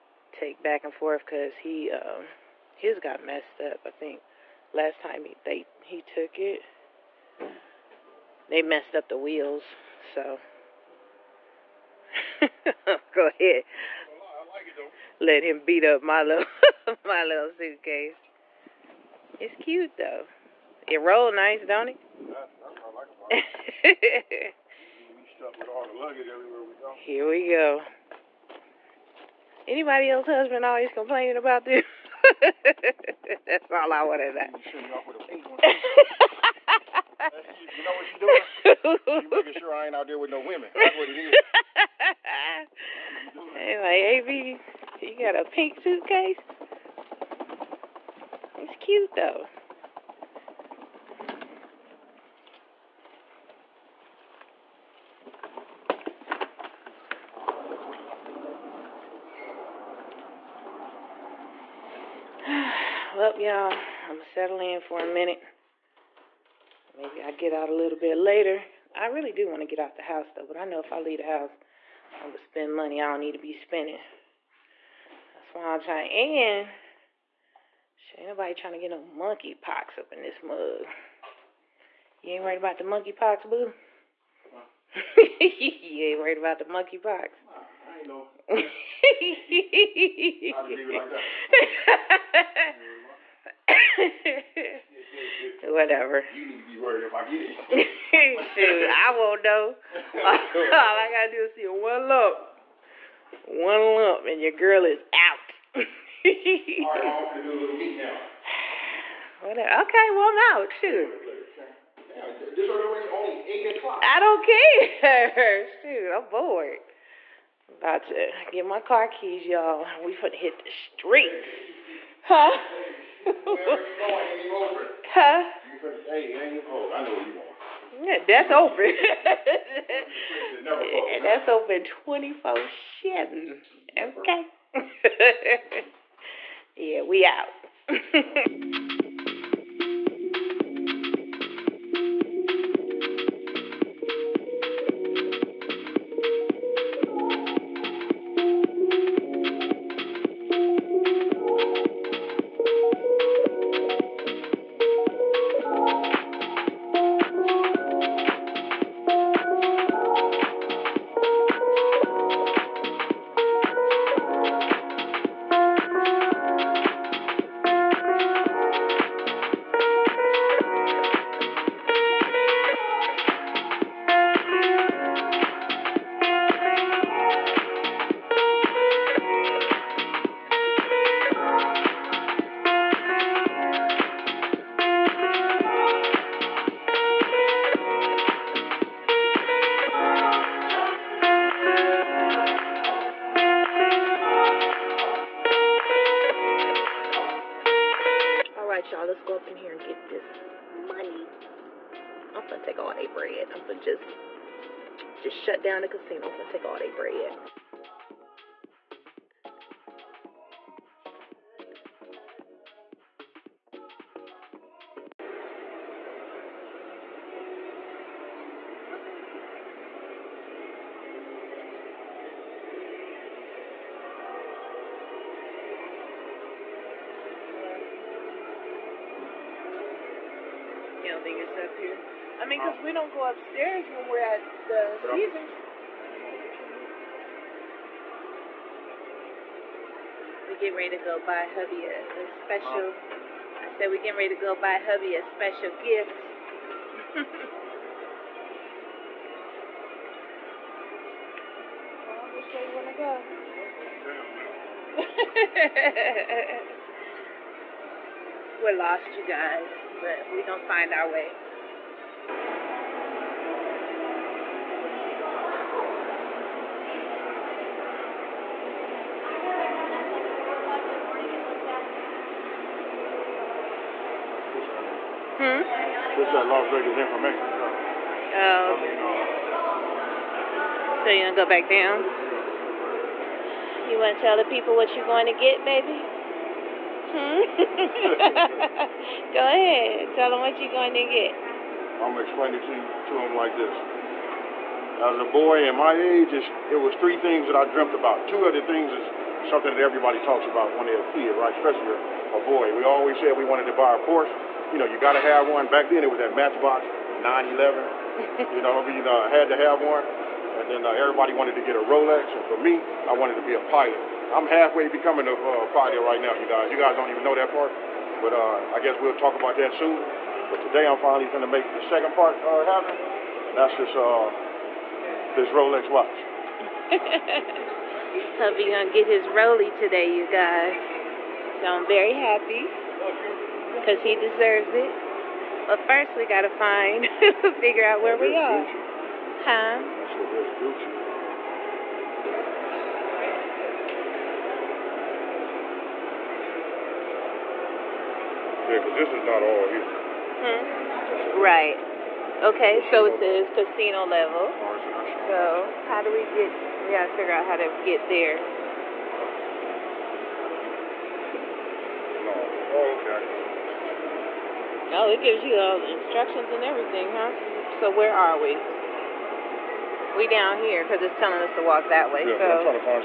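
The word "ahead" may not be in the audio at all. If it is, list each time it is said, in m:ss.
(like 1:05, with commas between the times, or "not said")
0:13, 4:49.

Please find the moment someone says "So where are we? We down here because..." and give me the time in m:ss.
6:07.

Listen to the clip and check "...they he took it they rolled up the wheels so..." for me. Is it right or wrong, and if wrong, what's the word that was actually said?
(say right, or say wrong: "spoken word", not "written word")
wrong: "messed", not "rolled".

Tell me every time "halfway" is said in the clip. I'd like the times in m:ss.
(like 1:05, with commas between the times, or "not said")
5:14.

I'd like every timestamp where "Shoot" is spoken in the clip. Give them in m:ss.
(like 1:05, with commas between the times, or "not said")
1:38, 1:50, 1:55.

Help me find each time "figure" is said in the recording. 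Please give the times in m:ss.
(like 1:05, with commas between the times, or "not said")
5:37, 5:57.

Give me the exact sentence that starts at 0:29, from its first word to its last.
Anybody else husband always complaining about this?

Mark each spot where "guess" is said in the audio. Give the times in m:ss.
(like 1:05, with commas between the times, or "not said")
5:18.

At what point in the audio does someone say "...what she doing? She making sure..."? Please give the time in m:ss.
0:37.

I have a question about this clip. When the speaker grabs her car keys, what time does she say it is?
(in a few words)
8 o'clock.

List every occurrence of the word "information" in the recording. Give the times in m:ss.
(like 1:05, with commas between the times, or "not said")
4:36.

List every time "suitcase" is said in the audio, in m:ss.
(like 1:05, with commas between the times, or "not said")
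0:17, 0:45.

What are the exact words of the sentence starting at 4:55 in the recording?
As a boy in my age, it was three things that I dreamt about.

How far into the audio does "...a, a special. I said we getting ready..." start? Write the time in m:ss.
4:01.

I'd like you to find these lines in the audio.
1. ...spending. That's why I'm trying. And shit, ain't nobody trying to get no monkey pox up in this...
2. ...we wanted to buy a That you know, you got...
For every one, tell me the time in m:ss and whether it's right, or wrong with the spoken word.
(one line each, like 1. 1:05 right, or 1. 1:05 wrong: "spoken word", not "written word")
1. 1:13 right
2. 5:03 wrong: "Porsche", not "That".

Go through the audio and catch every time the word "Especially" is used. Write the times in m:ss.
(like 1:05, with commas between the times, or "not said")
5:01.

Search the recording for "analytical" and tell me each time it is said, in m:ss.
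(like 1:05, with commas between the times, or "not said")
not said.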